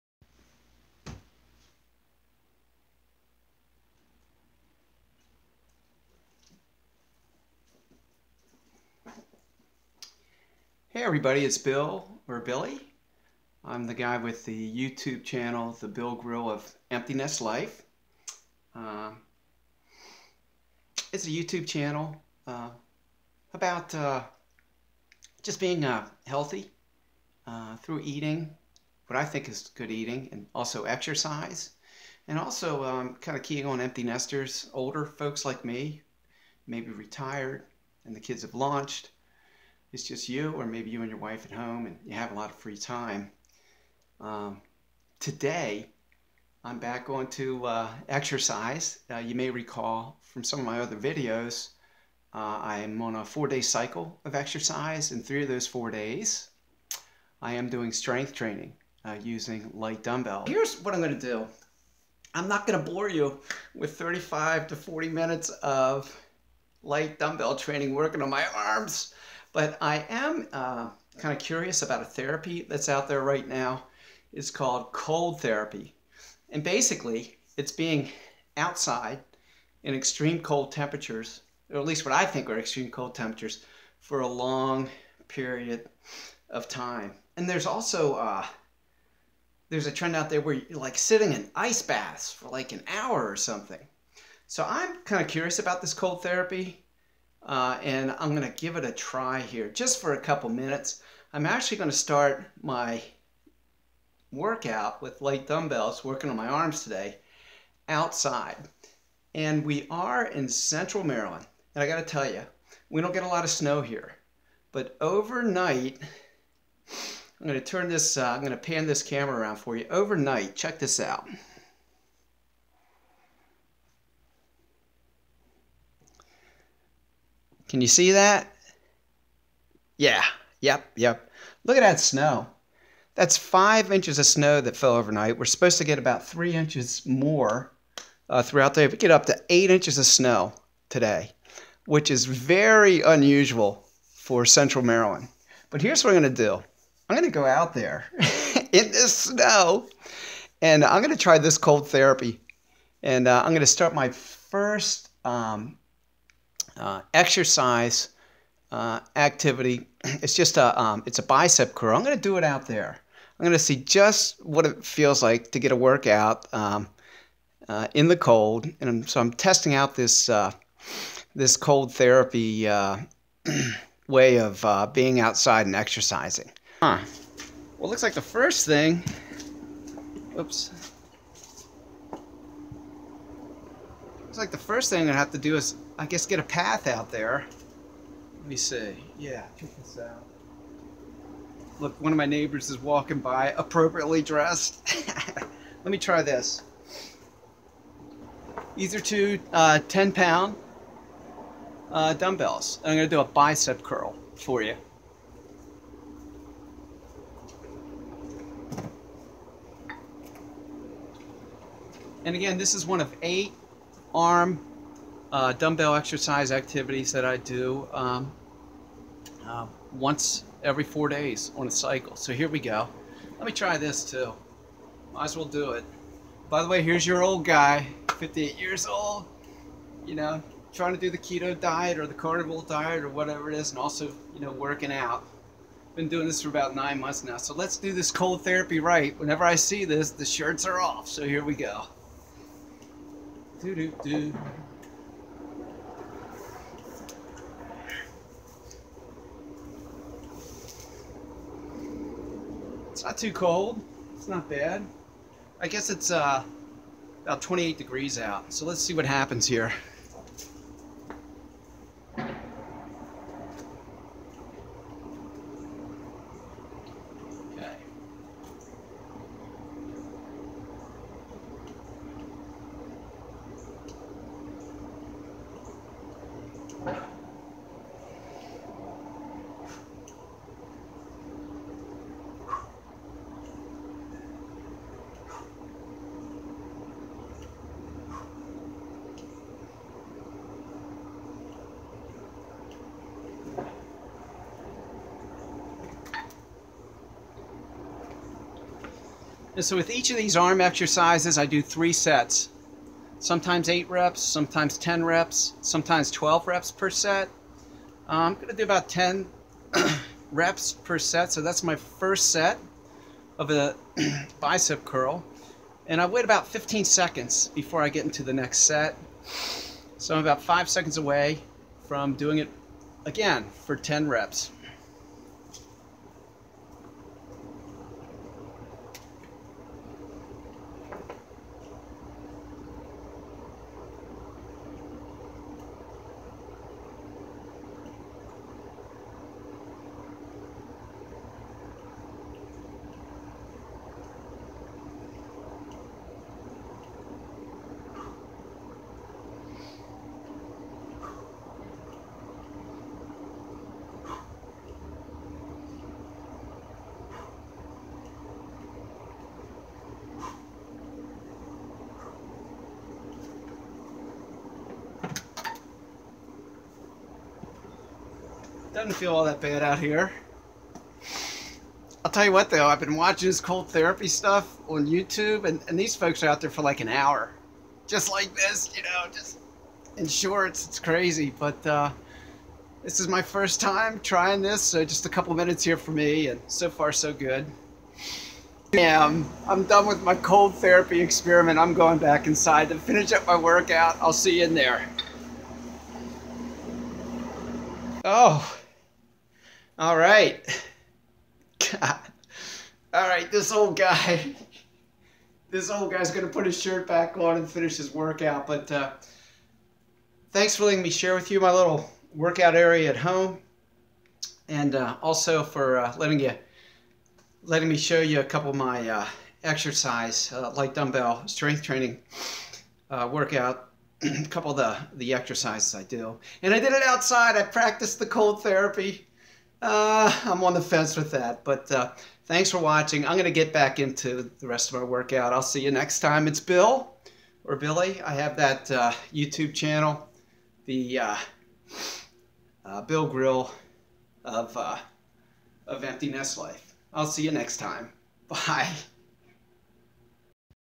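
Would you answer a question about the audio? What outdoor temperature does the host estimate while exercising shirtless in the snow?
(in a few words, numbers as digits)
28 degrees.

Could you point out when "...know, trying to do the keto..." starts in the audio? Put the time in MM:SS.
03:50.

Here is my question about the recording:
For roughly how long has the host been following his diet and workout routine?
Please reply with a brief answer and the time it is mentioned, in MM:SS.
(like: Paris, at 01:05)
9 months, at 03:56.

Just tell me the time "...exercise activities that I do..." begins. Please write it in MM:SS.
03:35.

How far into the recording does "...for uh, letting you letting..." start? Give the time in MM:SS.
06:55.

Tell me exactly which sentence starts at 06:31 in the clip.
I'm going back inside to finish up my workout.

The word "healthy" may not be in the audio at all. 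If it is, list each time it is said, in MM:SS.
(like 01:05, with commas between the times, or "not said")
00:26.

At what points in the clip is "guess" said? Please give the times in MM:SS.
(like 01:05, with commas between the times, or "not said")
03:06, 04:15.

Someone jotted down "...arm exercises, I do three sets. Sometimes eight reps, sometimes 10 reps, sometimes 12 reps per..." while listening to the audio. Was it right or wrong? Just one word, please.
right.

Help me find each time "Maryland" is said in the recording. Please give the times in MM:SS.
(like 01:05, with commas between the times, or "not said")
01:51, 02:24.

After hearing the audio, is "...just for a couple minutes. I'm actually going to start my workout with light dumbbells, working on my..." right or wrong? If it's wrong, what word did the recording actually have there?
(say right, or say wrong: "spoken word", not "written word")
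right.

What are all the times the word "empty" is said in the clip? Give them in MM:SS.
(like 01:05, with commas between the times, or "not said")
00:16, 00:33, 07:25.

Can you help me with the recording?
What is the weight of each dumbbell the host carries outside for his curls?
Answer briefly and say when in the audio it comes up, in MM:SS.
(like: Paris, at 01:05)
10 pounds, at 03:19.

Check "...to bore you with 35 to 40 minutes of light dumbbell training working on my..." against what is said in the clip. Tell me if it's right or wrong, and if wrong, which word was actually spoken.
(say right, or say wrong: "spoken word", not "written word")
right.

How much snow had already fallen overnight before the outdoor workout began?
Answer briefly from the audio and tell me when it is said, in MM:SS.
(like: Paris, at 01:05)
5 inches, at 02:13.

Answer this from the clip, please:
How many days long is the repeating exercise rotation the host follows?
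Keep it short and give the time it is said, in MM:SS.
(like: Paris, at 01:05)
4, at 00:53.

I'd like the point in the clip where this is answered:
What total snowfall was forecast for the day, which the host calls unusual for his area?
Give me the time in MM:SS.
02:19.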